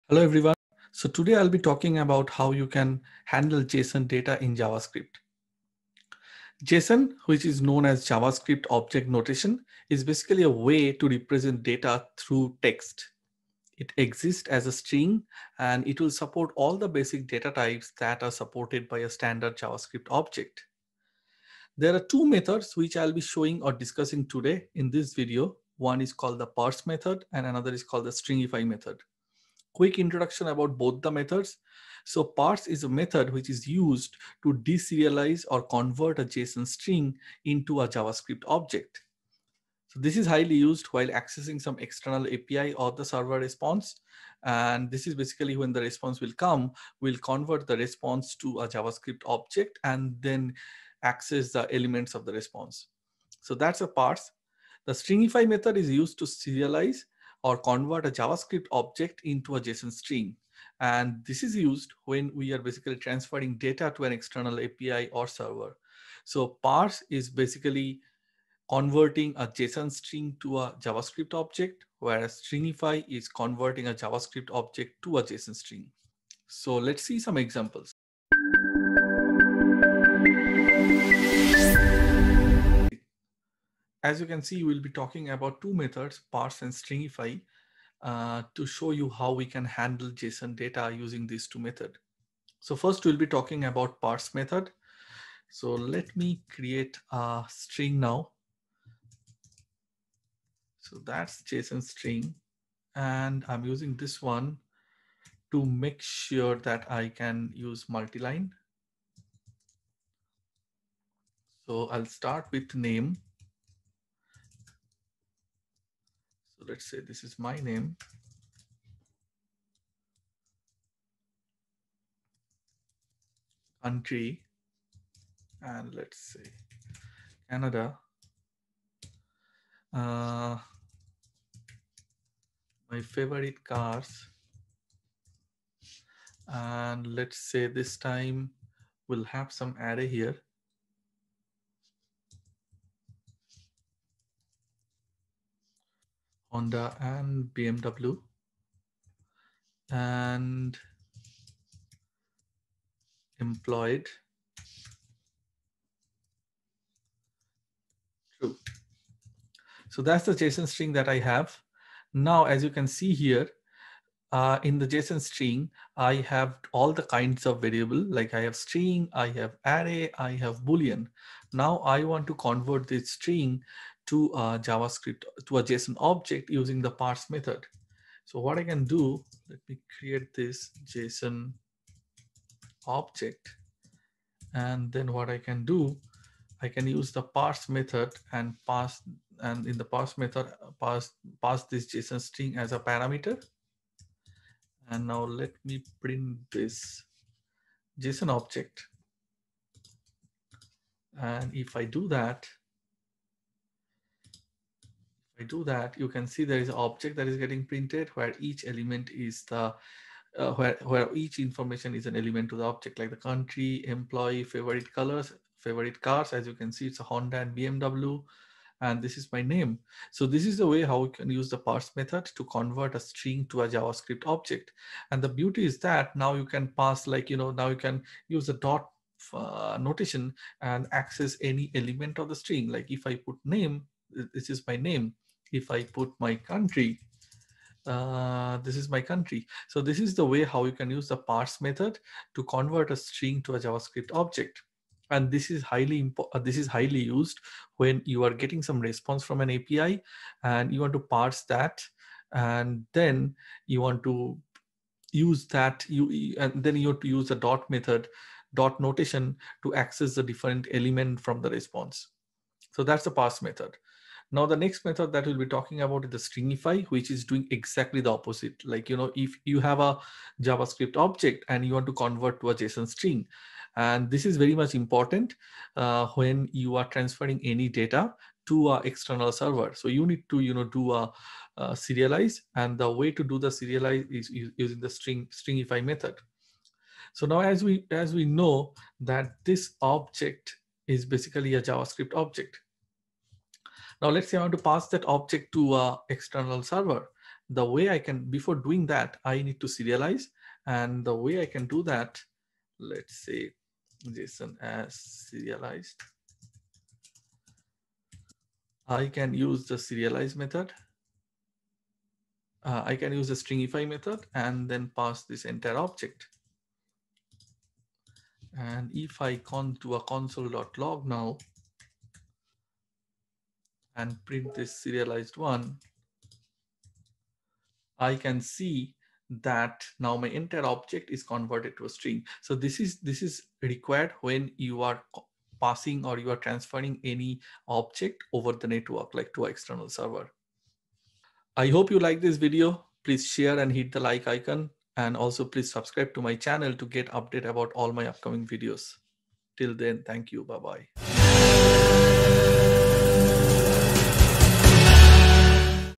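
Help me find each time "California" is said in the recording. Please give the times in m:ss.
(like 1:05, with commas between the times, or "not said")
not said.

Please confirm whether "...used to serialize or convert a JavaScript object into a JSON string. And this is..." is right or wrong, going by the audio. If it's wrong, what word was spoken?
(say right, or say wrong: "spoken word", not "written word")
right.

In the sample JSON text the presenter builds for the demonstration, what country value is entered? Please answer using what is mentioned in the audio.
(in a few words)
Canada.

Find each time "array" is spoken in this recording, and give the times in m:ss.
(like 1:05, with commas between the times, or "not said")
2:19, 2:49.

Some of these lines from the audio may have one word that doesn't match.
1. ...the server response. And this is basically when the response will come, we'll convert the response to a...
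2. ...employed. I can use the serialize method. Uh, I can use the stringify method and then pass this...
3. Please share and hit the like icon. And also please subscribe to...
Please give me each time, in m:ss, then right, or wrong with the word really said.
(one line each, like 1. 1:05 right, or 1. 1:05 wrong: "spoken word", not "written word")
1. 0:42 right
2. 5:04 wrong: "serialized", not "employed"
3. 5:43 right.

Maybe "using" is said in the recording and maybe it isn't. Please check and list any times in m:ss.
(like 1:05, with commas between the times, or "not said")
1:30, 1:43, 2:56, 4:44.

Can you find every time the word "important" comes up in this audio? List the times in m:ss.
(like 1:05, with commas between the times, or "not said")
4:34.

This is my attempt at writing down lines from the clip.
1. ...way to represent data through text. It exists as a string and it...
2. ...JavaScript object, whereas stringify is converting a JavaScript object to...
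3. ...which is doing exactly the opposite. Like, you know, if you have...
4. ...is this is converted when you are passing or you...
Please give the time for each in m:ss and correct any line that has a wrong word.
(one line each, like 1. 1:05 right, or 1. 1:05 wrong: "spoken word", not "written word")
1. 0:10 right
2. 1:10 right
3. 4:26 right
4. 5:32 wrong: "required", not "converted".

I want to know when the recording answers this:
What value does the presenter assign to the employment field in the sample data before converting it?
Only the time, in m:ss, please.
2:38.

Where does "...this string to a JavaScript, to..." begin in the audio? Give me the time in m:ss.
2:52.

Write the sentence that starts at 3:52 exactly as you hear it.
Like if I put name, this is my name if I put my country, uh, this is my country.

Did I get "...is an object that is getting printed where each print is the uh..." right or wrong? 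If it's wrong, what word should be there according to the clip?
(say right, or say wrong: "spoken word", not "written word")
wrong: "element", not "print".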